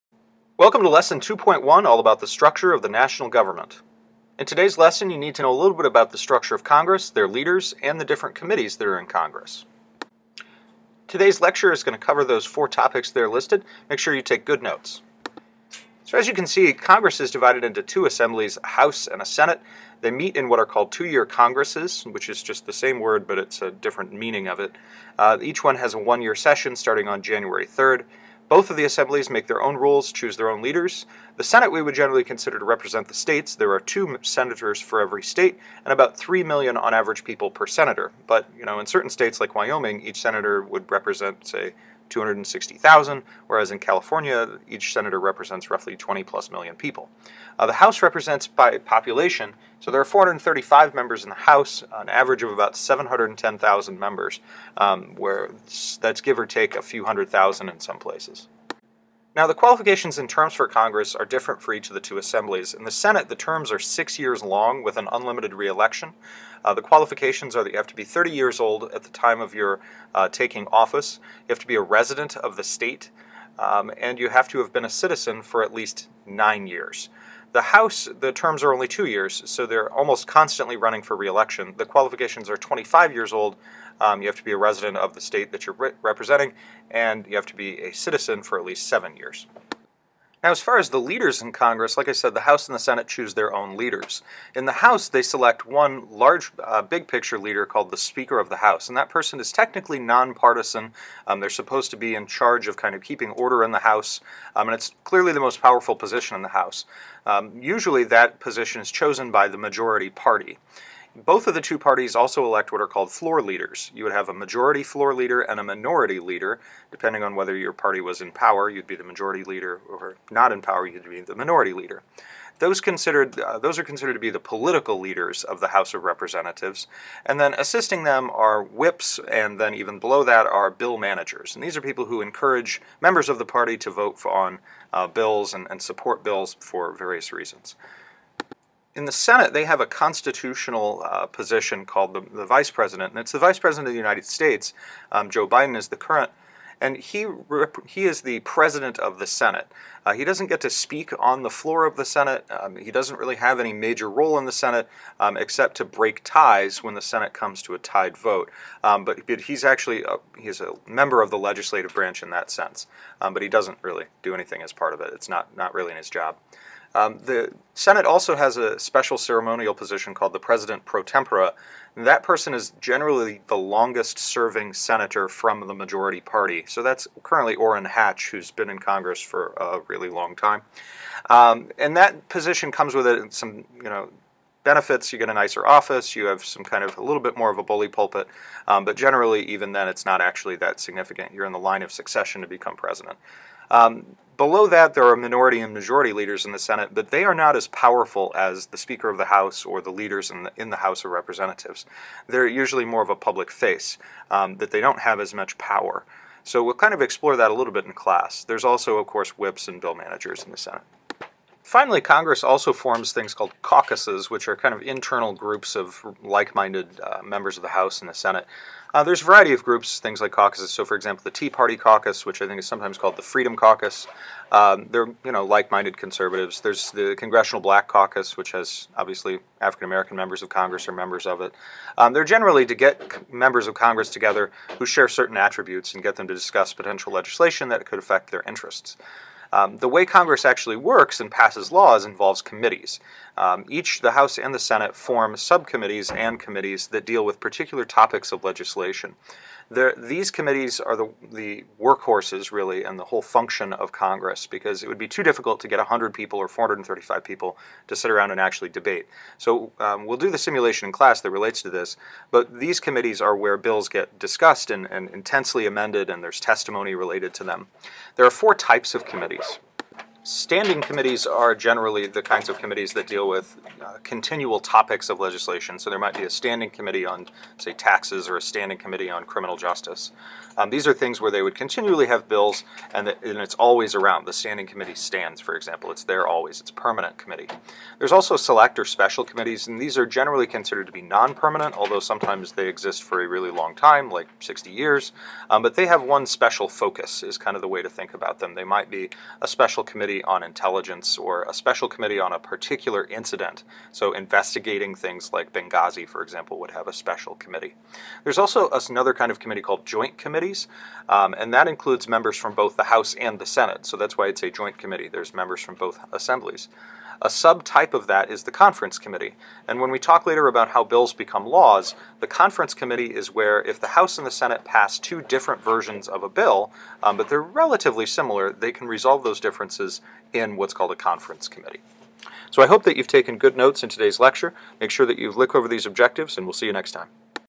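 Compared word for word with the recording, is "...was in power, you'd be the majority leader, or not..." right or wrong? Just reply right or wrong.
right.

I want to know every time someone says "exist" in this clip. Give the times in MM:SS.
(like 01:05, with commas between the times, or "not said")
04:52.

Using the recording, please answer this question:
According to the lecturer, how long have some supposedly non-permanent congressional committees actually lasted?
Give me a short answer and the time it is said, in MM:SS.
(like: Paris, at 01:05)
60 years, at 04:54.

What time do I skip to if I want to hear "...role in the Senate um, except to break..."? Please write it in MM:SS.
02:34.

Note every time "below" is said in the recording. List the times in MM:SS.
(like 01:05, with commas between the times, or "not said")
02:09, 03:14.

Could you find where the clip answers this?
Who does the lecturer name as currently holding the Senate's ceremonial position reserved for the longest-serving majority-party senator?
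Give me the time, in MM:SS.
02:57.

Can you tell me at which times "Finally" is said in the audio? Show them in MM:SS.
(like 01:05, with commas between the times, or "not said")
03:31.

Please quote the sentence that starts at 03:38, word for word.
Uh, there's a variety of groups, things like caucuses.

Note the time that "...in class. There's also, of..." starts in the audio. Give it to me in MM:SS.
03:27.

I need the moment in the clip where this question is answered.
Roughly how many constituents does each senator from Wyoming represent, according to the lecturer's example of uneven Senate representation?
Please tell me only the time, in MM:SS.
00:42.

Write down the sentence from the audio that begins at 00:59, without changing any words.
Now, the qualifications and terms for Congress are different for each of the two assemblies.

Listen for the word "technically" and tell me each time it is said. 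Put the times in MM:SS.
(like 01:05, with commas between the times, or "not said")
01:39.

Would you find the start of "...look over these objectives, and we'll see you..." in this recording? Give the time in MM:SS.
05:35.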